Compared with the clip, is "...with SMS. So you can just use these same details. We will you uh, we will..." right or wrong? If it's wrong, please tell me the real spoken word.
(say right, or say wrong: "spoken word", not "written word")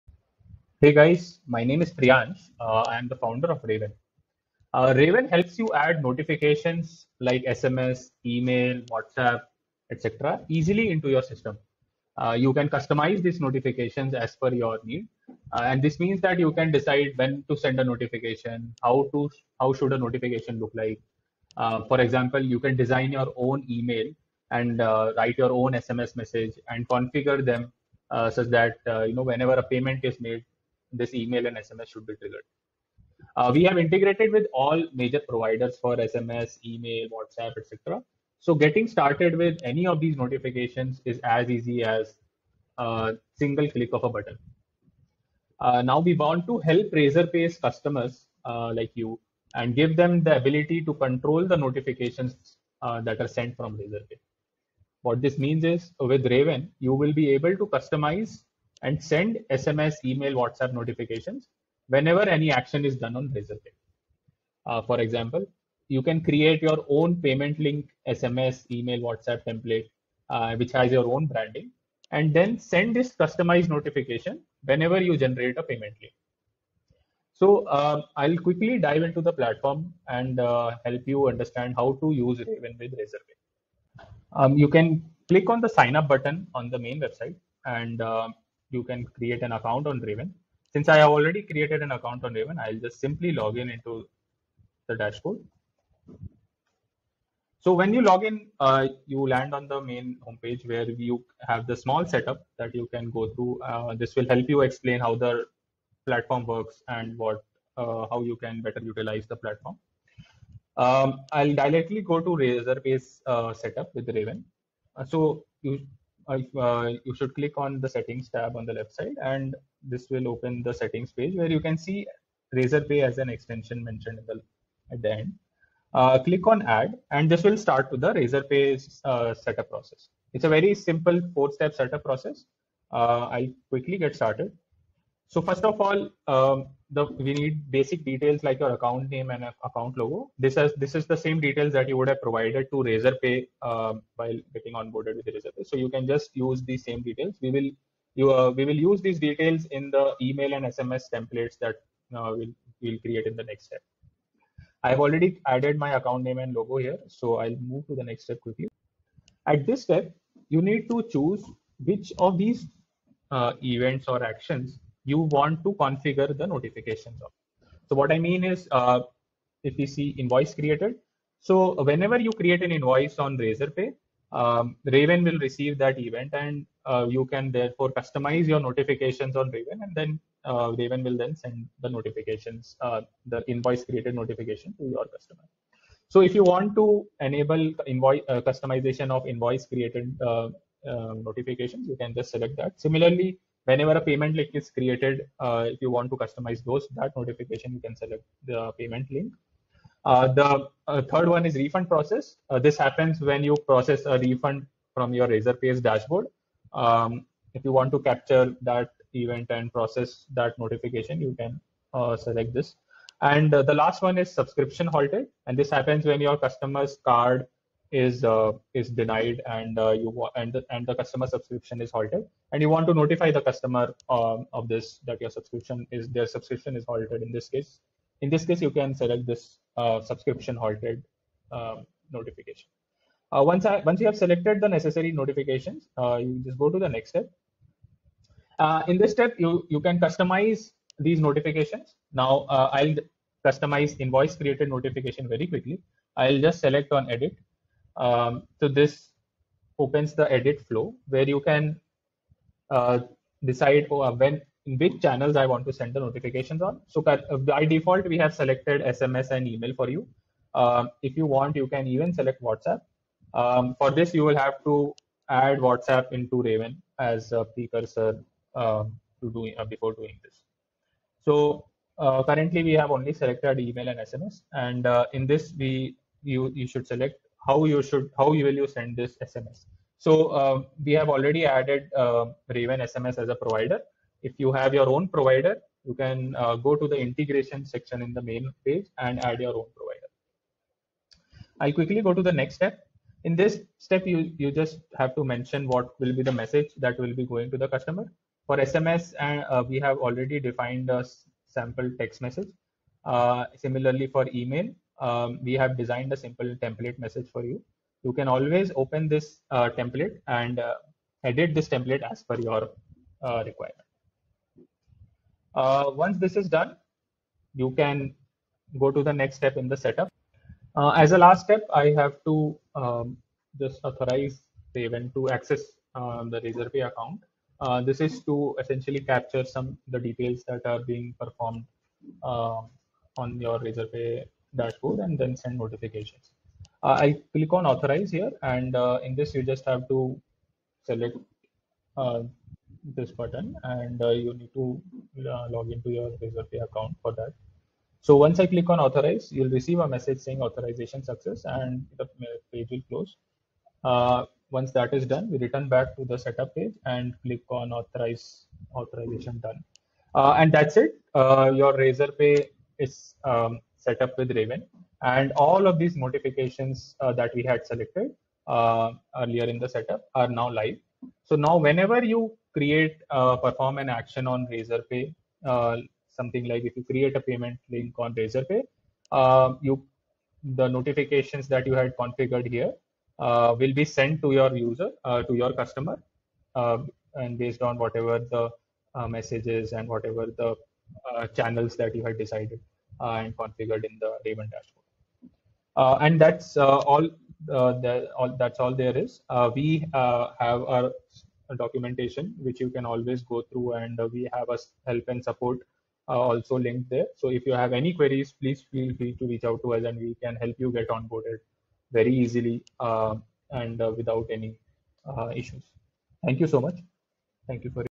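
wrong: "Razorpay", not "SMS".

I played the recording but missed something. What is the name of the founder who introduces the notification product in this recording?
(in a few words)
Priyansh.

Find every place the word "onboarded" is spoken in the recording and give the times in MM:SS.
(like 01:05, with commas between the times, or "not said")
02:24, 06:50.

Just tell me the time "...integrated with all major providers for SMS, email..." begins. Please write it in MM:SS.
00:33.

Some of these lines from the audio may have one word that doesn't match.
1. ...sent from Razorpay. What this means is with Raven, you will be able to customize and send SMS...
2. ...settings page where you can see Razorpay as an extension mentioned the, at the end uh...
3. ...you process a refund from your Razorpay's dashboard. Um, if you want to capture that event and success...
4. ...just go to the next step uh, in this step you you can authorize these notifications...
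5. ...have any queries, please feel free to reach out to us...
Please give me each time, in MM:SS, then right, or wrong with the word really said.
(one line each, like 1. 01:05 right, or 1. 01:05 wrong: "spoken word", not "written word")
1. 00:53 right
2. 02:00 right
3. 03:23 wrong: "process", not "success"
4. 03:56 wrong: "customize", not "authorize"
5. 06:47 right.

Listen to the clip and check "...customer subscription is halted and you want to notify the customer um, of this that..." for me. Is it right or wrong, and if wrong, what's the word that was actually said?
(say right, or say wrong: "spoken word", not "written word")
right.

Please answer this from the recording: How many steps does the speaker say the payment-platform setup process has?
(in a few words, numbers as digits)
4.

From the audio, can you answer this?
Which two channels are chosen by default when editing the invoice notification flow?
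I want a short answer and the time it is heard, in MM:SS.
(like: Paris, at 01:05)
SMS and email, at 04:18.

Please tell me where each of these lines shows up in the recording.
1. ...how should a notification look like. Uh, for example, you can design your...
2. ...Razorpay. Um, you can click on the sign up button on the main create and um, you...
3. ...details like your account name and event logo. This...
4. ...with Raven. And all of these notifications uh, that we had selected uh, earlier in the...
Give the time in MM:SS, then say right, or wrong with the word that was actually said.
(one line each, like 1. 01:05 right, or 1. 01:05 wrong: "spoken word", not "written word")
1. 00:19 right
2. 01:22 wrong: "website", not "create"
3. 02:18 wrong: "account", not "event"
4. 06:04 right.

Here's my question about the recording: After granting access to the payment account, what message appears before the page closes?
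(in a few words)
authorization success.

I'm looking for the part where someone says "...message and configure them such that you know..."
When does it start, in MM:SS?
00:26.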